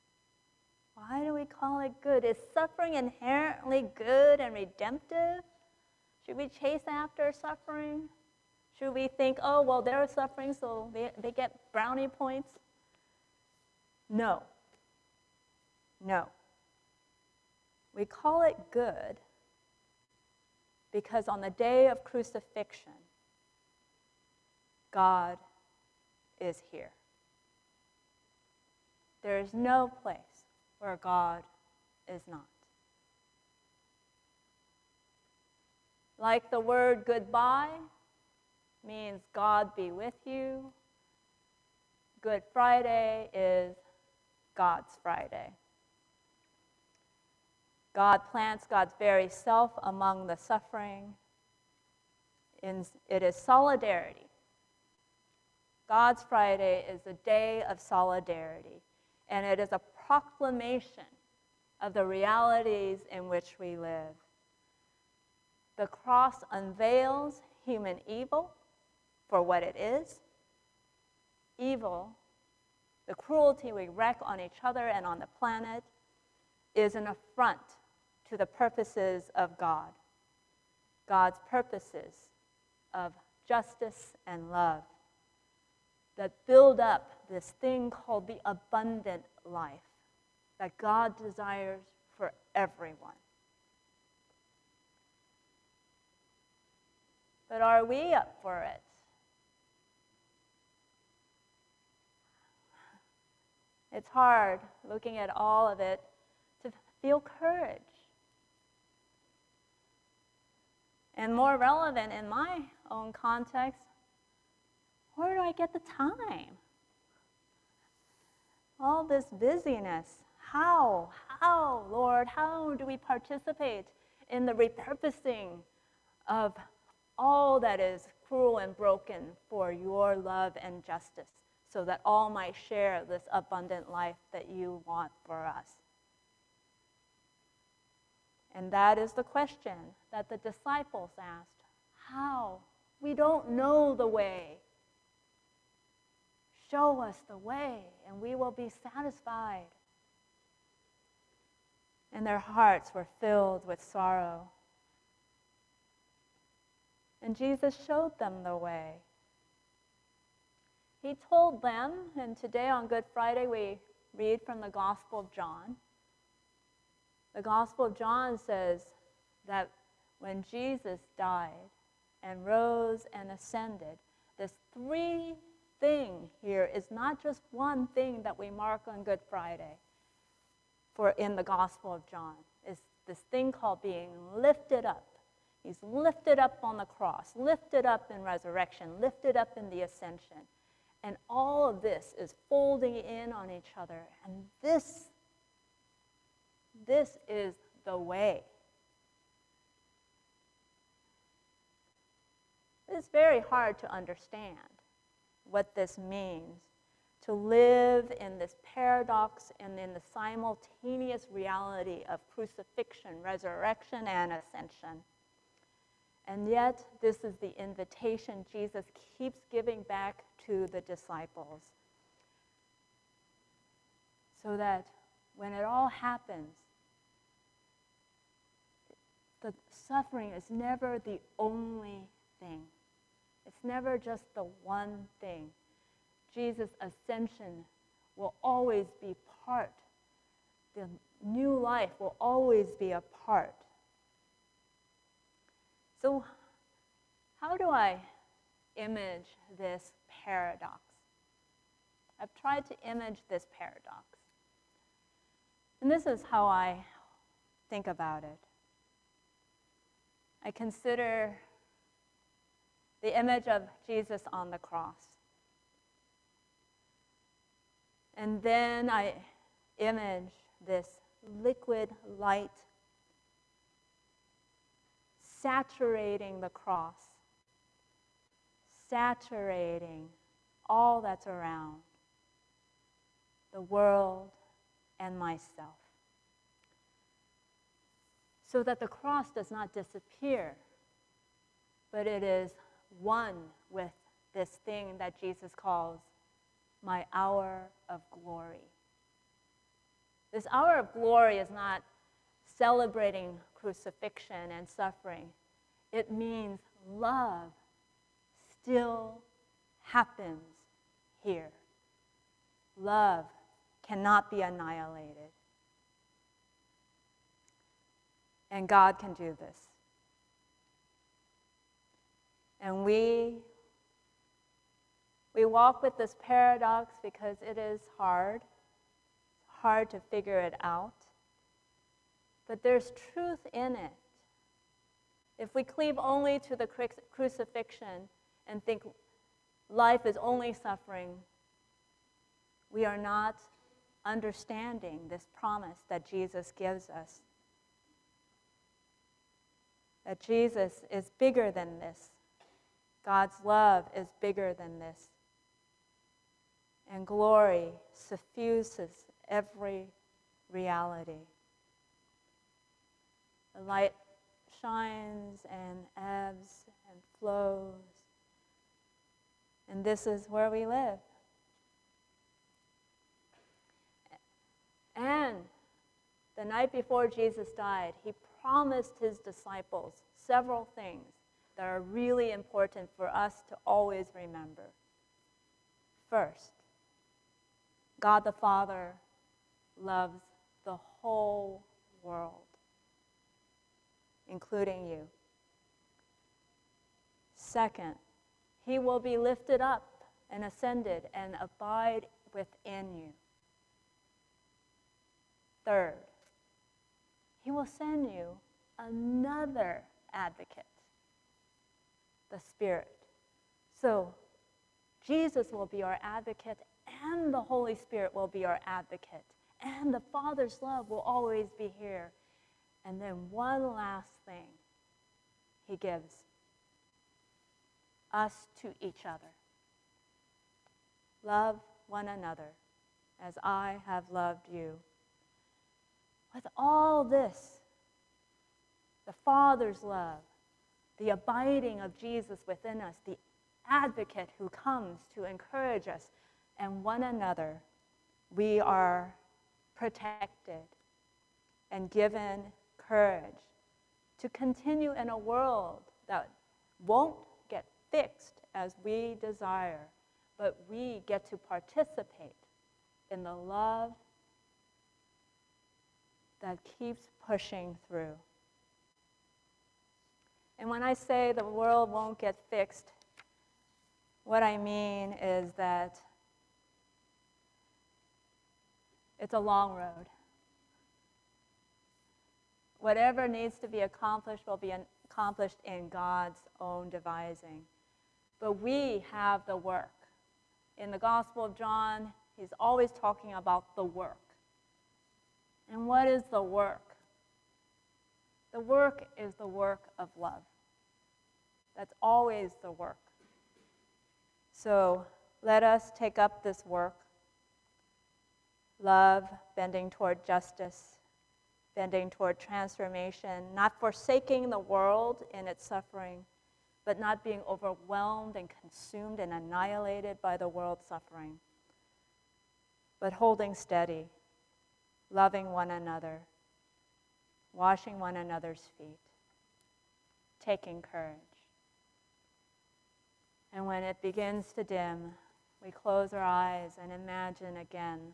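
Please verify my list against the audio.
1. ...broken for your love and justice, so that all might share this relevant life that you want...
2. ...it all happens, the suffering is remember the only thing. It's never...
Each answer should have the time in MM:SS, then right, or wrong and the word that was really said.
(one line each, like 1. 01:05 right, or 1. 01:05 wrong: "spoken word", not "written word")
1. 02:08 wrong: "abundant", not "relevant"
2. 03:45 wrong: "never", not "remember".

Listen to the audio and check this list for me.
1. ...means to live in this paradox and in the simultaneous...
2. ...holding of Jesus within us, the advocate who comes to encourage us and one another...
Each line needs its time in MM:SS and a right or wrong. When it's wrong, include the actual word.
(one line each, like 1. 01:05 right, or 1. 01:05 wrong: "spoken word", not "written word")
1. 03:25 right
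2. 07:21 wrong: "abiding", not "holding".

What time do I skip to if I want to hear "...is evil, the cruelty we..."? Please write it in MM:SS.
01:09.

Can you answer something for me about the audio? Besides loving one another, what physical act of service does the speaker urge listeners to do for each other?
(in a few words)
washing one another's feet.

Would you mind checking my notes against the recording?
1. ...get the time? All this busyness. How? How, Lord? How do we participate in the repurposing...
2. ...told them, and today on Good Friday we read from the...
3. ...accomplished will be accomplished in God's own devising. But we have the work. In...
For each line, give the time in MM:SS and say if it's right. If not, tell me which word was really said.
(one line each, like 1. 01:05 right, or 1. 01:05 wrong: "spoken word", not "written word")
1. 01:55 right
2. 02:41 right
3. 08:03 right.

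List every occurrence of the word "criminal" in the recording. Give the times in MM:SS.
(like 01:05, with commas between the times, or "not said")
not said.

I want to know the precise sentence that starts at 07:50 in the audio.
And when I say the world won't get fixed, what I mean is that it's a long road.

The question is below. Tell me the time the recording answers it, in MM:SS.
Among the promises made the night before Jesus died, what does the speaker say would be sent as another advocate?
06:52.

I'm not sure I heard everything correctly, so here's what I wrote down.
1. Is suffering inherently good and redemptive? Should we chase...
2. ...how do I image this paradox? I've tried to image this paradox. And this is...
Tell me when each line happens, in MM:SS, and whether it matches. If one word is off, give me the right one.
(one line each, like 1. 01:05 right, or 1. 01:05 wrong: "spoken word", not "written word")
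1. 00:02 right
2. 04:07 right.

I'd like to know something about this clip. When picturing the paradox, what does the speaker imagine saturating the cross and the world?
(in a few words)
liquid light.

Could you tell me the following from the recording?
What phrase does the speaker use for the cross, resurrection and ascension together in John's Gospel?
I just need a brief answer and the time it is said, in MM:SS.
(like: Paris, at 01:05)
being lifted up, at 03:03.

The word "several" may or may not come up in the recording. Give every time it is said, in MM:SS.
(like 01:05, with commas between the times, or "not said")
06:20.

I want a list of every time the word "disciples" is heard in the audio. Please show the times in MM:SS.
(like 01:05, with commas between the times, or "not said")
02:20, 03:40, 06:19.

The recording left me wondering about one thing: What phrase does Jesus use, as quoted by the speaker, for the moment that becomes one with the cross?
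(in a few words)
my hour of glory.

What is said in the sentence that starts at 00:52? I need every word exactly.
It is solidarity God's Friday is a day of solidarity, and it is a proclamation of the realities in which we live.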